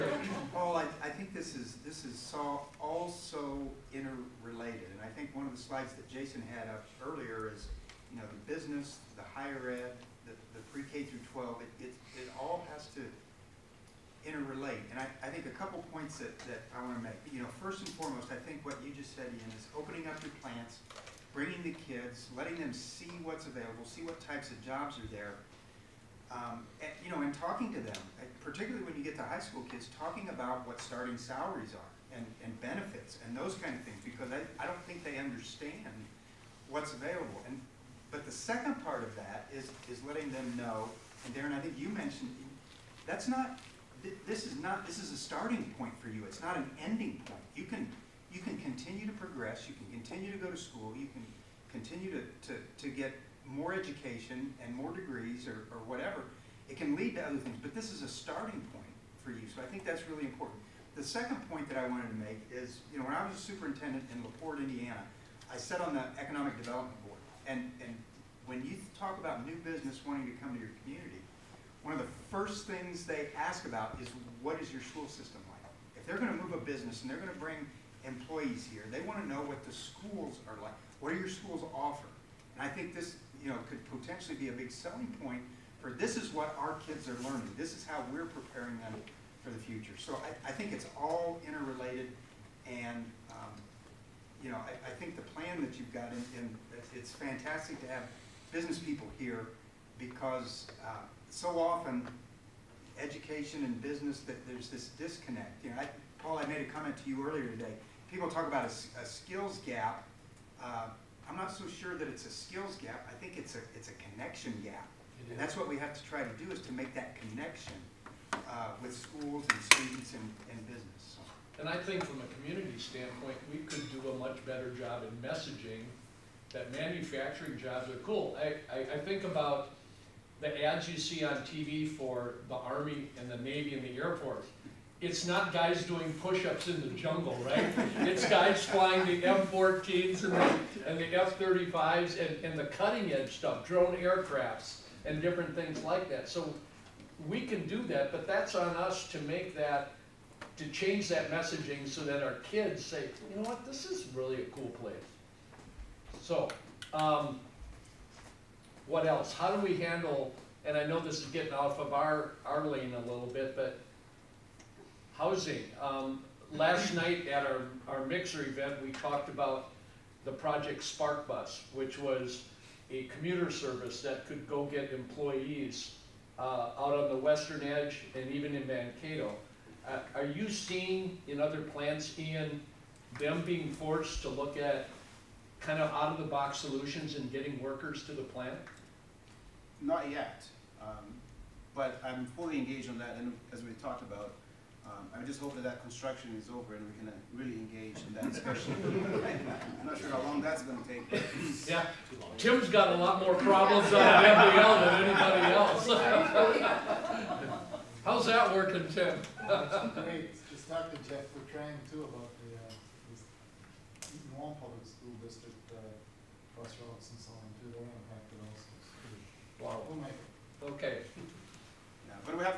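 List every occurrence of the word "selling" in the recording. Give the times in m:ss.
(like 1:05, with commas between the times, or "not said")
1:24.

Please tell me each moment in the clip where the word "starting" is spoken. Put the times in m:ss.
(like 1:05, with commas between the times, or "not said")
0:30, 0:45, 0:58.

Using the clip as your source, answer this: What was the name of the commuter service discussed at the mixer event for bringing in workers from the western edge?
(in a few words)
Project Spark Bus.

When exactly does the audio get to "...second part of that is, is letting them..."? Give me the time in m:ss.
0:38.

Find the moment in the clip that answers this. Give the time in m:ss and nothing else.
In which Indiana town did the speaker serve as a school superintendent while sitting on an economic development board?
1:04.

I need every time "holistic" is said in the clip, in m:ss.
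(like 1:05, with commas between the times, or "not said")
not said.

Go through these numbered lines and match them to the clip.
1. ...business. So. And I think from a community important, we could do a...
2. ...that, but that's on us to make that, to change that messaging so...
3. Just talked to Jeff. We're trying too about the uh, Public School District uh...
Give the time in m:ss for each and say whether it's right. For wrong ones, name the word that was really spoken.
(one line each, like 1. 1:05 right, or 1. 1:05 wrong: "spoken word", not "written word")
1. 2:00 wrong: "standpoint", not "important"
2. 2:27 right
3. 3:30 right.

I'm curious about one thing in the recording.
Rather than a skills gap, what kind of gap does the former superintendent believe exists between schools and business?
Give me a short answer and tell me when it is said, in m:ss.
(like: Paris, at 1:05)
Connection gap, at 1:54.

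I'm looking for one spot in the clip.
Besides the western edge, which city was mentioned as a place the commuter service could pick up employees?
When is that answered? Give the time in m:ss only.
2:58.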